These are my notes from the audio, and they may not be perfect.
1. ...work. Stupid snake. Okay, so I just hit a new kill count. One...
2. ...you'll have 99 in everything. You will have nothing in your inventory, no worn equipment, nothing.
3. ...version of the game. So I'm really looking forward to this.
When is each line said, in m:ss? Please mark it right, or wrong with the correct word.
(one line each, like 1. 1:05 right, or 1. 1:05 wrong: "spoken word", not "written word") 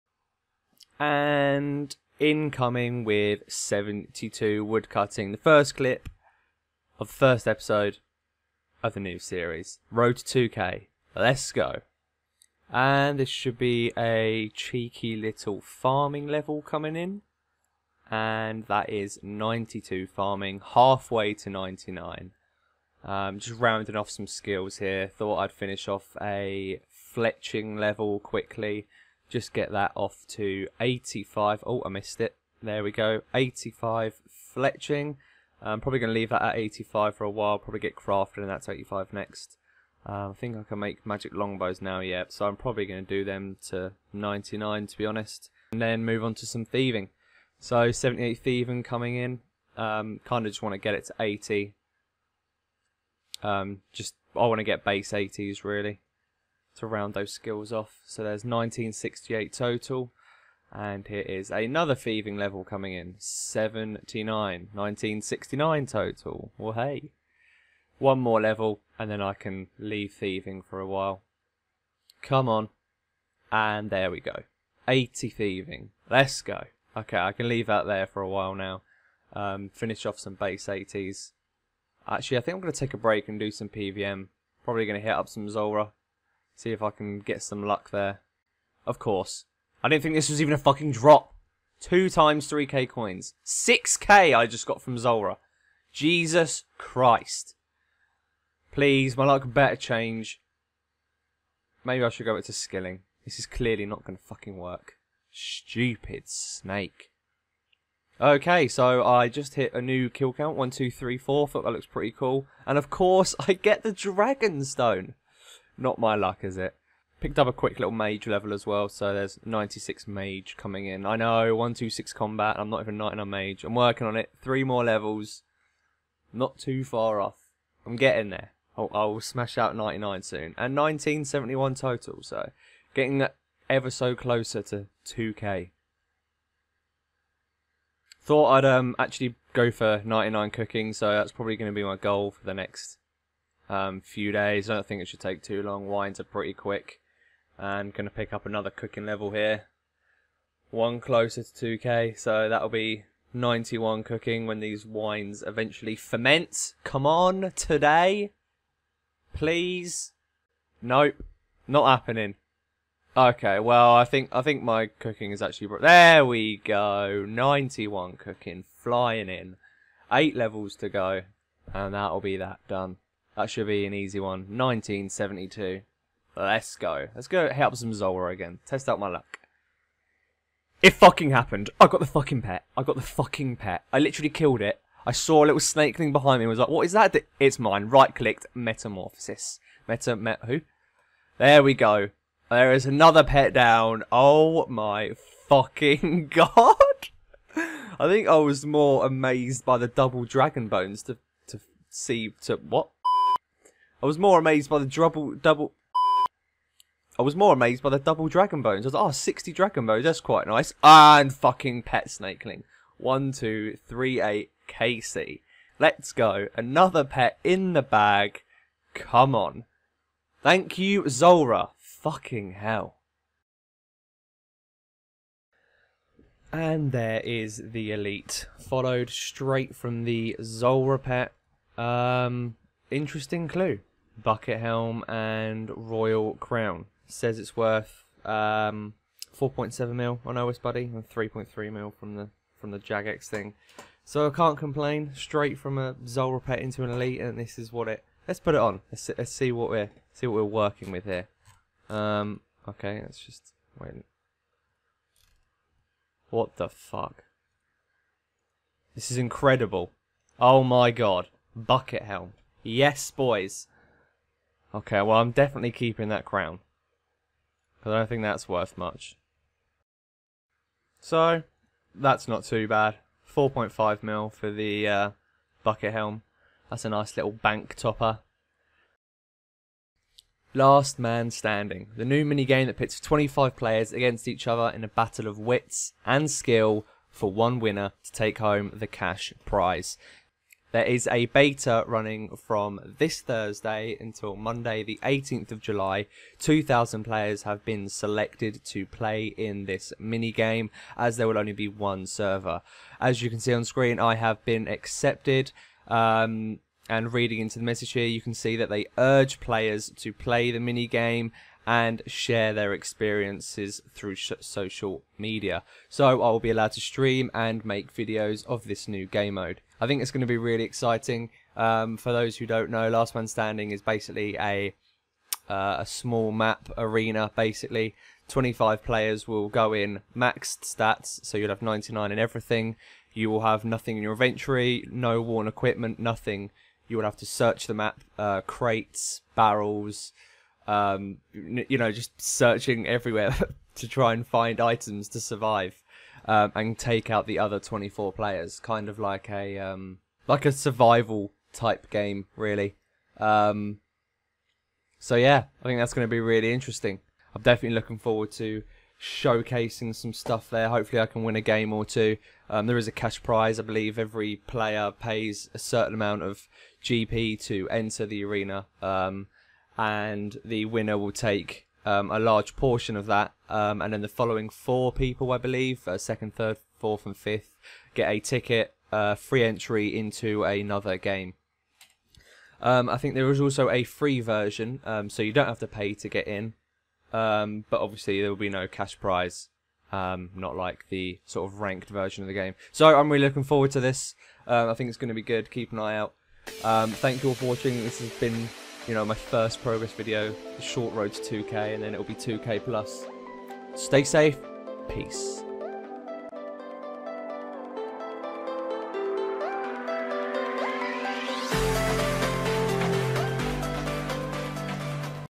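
1. 1:44 right
2. 5:31 right
3. 6:31 right.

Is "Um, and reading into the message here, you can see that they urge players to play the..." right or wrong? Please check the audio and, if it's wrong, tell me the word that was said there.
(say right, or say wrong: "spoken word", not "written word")
right.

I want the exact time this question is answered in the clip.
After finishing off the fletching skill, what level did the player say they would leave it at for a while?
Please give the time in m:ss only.
0:35.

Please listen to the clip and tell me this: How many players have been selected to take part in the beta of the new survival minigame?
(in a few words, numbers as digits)
2,000.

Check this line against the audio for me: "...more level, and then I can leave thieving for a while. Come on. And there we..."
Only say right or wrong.
right.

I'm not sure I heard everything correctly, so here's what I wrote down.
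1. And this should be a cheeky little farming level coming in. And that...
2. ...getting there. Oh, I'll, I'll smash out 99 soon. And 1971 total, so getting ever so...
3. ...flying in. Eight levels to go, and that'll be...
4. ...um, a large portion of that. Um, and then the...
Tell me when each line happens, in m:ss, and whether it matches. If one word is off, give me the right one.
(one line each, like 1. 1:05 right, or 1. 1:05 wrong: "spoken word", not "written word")
1. 0:12 right
2. 2:07 right
3. 2:48 right
4. 6:11 right.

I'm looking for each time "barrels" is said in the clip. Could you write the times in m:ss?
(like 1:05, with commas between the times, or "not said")
5:39.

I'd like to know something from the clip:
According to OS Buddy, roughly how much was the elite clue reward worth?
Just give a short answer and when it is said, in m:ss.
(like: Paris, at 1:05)
4.7 mil, at 3:59.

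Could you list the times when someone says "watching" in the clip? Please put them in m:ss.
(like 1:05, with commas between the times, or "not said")
6:37.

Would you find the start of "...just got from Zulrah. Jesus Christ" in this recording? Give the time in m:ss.
1:34.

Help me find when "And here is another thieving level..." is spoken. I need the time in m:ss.
1:00.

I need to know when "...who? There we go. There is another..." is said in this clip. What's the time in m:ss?
3:10.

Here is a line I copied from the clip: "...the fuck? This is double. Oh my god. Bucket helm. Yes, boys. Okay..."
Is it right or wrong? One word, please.
wrong.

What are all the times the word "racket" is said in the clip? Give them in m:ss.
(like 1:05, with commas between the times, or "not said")
not said.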